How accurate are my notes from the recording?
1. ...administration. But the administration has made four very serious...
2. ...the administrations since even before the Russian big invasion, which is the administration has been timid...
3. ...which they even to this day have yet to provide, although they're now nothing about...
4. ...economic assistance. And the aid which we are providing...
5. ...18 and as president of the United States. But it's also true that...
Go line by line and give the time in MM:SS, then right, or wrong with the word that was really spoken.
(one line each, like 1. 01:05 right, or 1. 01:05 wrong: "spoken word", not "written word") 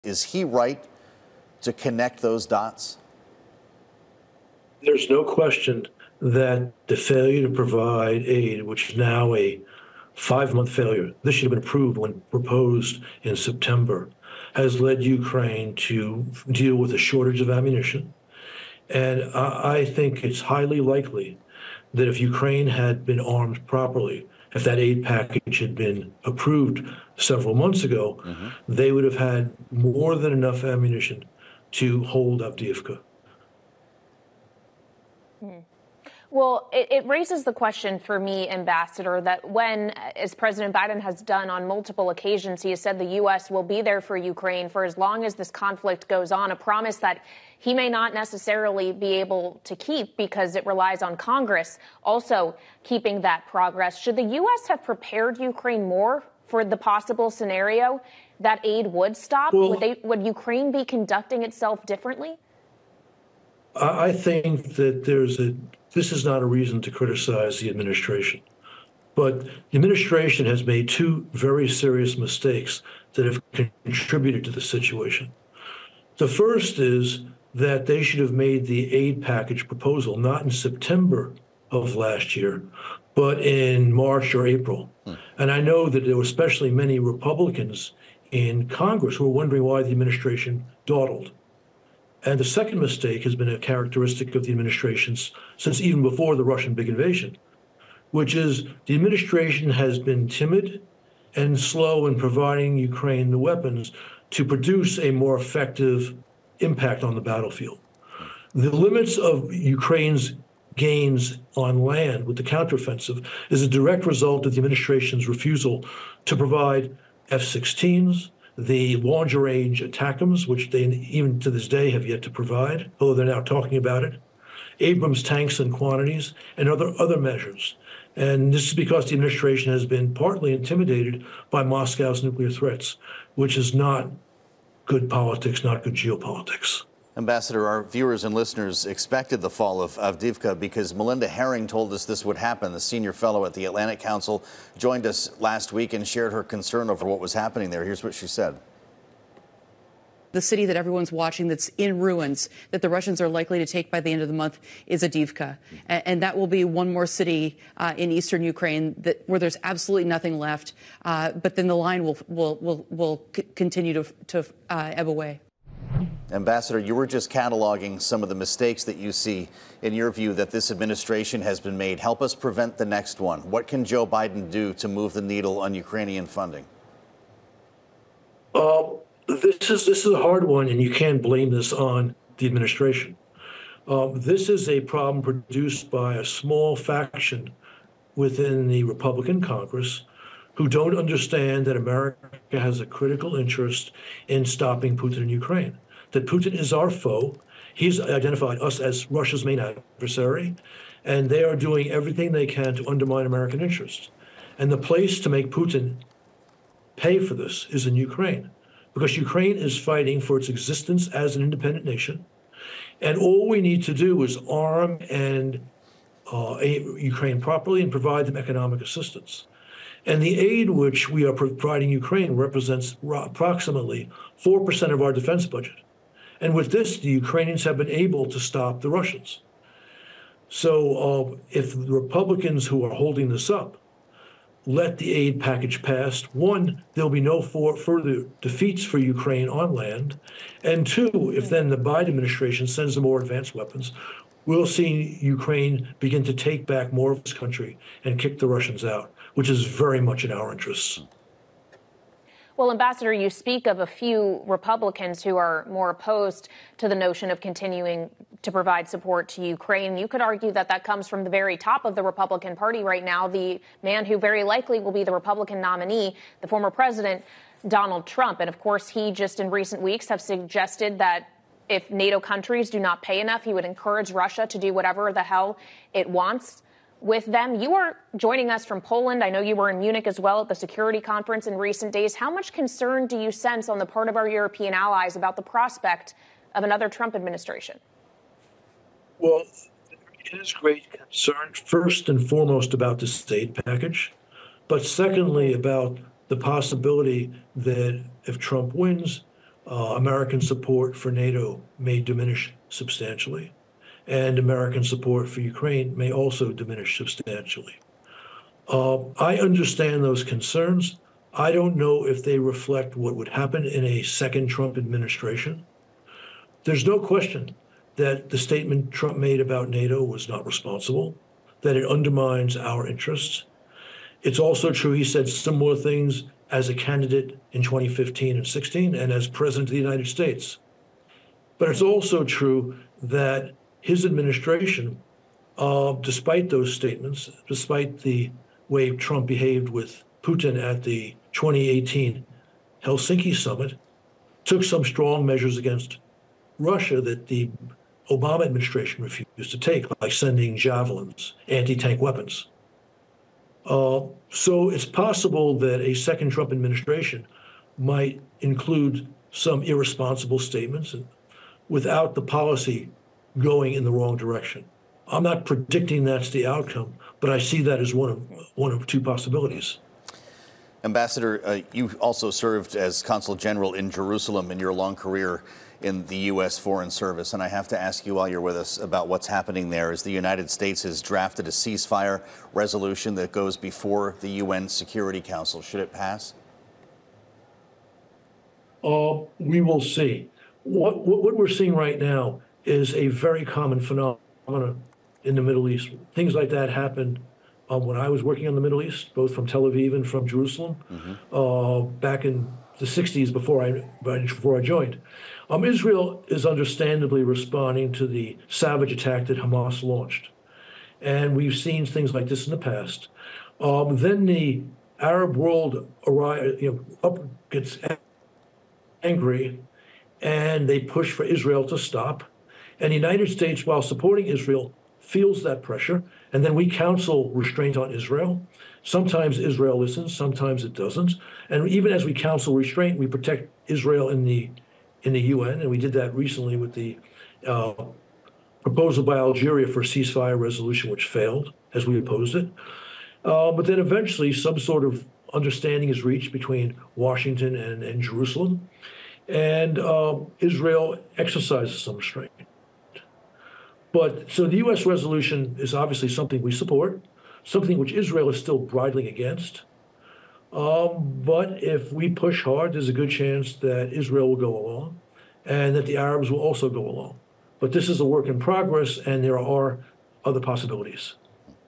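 1. 01:07 wrong: "two", not "four"
2. 01:34 right
3. 02:00 wrong: "talking", not "nothing"
4. 03:38 right
5. 05:28 wrong: "16", not "18".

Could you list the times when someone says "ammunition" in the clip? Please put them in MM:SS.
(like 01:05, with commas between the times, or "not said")
00:17, 00:30.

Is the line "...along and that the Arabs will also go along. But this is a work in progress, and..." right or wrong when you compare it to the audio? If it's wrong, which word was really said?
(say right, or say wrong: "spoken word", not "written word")
right.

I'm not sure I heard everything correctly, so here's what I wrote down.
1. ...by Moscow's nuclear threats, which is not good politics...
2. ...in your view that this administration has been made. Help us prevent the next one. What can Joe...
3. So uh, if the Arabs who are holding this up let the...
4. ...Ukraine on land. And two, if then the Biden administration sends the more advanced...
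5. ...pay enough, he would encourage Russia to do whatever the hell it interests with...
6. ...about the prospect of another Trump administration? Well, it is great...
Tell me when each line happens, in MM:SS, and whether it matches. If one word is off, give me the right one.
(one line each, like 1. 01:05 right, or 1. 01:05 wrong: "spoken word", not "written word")
1. 02:11 right
2. 02:49 right
3. 03:50 wrong: "Republicans", not "Arabs"
4. 03:58 right
5. 04:33 wrong: "wants", not "interests"
6. 04:45 right.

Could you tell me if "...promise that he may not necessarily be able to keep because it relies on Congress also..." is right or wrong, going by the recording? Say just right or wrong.
right.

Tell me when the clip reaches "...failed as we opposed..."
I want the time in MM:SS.
07:21.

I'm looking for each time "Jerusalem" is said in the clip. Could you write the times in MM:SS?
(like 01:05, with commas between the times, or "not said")
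06:13, 06:40, 07:27.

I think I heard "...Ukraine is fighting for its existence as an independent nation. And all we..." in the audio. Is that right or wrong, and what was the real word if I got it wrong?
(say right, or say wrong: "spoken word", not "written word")
right.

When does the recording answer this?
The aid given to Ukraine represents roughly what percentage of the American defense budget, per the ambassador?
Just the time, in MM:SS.
03:44.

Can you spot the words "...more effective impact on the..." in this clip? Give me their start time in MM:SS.
01:45.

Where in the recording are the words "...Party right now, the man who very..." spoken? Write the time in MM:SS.
04:22.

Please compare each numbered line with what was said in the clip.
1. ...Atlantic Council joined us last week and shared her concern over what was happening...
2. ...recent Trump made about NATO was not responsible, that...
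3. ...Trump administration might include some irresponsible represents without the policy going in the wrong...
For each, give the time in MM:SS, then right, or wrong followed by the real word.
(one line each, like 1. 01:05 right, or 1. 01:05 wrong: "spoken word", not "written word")
1. 02:23 right
2. 05:18 wrong: "statement", not "recent"
3. 05:56 wrong: "statements", not "represents".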